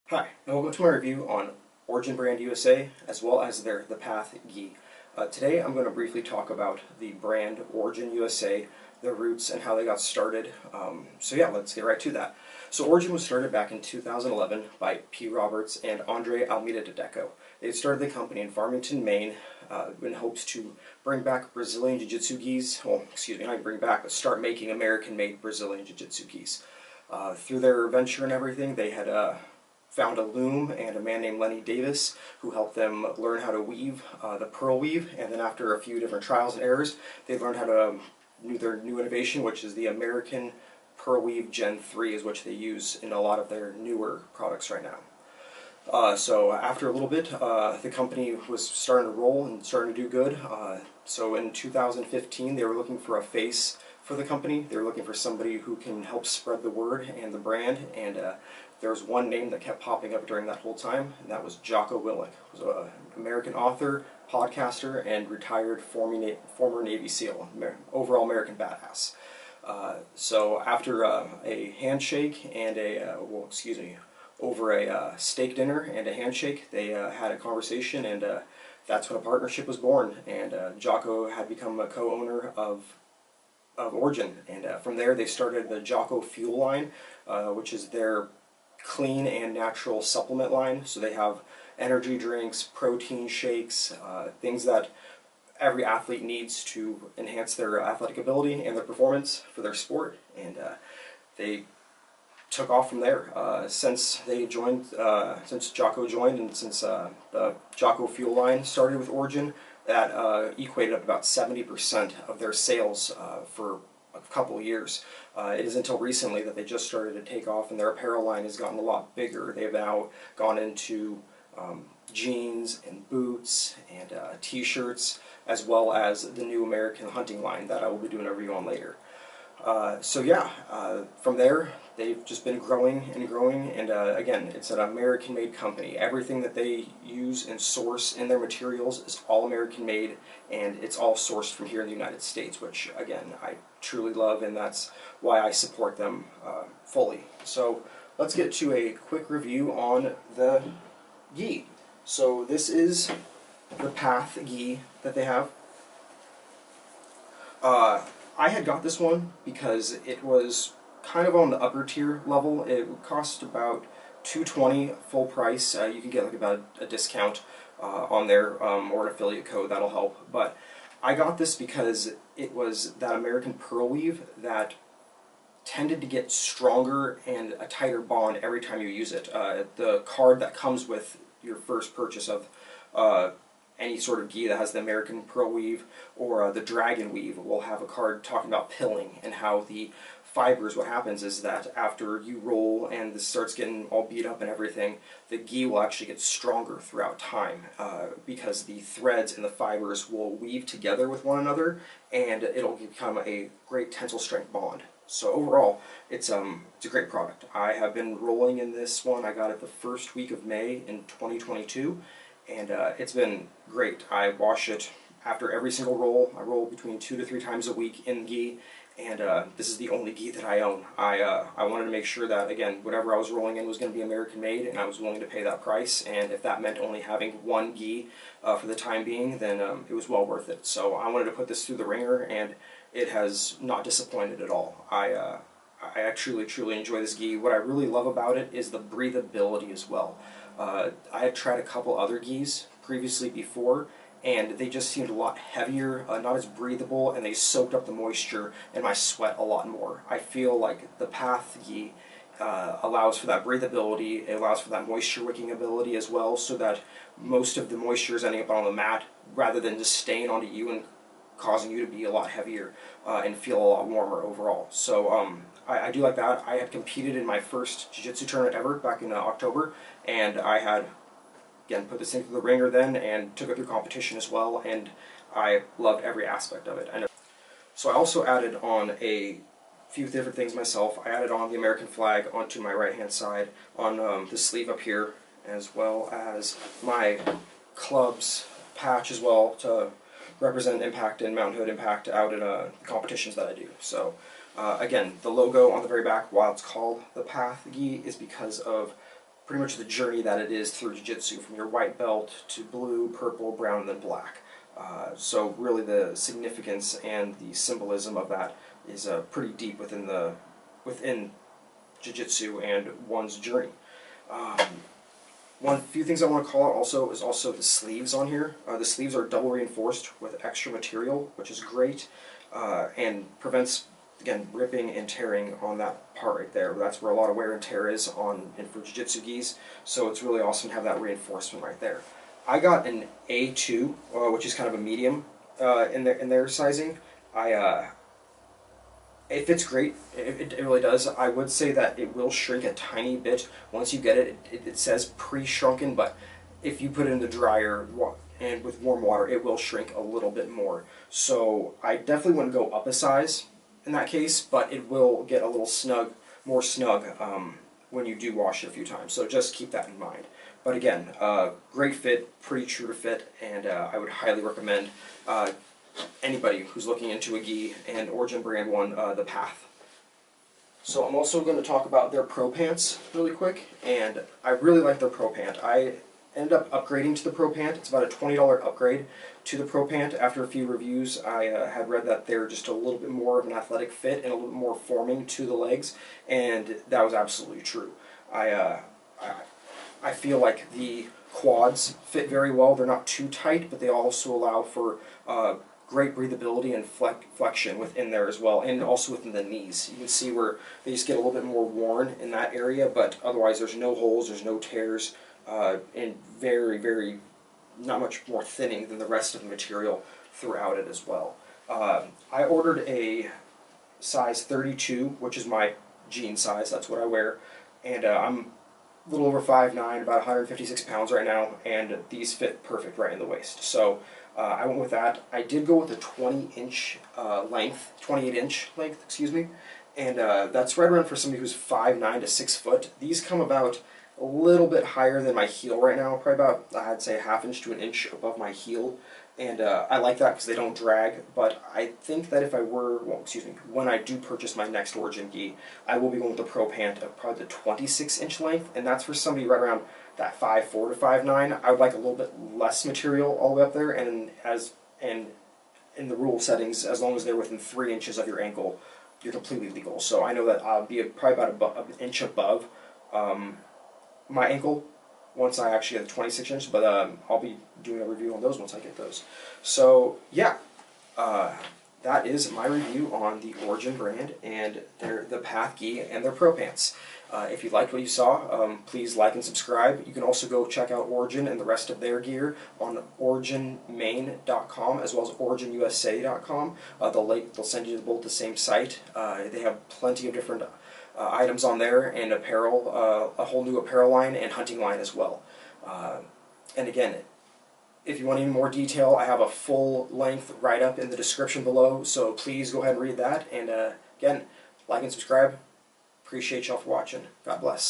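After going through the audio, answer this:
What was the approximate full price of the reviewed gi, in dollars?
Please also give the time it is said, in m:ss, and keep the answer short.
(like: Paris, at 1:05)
220, at 2:44.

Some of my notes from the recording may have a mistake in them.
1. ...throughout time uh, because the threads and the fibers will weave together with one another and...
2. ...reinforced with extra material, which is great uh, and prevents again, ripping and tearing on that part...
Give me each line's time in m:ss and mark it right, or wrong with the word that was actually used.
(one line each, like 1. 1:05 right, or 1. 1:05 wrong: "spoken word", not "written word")
1. 3:16 right
2. 5:19 right.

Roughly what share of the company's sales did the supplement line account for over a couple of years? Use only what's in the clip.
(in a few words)
70%.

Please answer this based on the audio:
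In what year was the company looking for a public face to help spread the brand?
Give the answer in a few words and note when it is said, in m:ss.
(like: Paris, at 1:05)
2015, at 0:51.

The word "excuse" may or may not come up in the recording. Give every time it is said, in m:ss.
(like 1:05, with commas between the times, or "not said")
0:23, 1:13, 7:09, 7:23.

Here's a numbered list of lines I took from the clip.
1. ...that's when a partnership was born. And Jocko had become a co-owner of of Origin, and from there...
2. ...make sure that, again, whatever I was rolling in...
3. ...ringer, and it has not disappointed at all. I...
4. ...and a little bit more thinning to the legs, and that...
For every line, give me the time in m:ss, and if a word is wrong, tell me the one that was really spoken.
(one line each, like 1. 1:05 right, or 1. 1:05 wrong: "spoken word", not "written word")
1. 1:18 right
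2. 3:41 right
3. 3:51 right
4. 6:24 wrong: "forming", not "thinning".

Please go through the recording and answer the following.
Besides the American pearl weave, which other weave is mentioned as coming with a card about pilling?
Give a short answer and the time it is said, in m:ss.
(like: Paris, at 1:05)
dragon weave, at 3:06.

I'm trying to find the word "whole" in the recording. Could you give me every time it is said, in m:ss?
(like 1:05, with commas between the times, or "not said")
1:00, 8:13.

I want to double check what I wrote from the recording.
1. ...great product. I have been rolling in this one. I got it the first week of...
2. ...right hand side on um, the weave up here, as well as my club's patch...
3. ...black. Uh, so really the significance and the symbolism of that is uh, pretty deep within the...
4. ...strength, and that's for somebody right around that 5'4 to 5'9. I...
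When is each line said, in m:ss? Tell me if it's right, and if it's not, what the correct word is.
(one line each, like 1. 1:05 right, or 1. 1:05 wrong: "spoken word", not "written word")
1. 3:26 right
2. 4:42 wrong: "sleeve", not "weave"
3. 5:03 right
4. 7:28 wrong: "length", not "strength".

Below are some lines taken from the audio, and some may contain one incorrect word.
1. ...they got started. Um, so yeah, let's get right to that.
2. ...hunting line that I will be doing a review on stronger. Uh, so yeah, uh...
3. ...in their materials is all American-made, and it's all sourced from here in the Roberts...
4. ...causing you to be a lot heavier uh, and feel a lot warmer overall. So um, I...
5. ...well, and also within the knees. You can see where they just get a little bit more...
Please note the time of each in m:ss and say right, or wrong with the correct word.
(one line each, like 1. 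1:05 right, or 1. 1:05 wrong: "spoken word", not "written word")
1. 0:09 right
2. 2:07 wrong: "later", not "stronger"
3. 2:18 wrong: "United", not "Roberts"
4. 4:21 right
5. 6:38 right.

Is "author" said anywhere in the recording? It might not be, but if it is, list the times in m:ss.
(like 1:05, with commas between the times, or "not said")
1:03.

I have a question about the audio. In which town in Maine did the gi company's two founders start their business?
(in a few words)
Farmington.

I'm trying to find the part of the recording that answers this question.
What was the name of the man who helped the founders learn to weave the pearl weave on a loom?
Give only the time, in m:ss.
0:31.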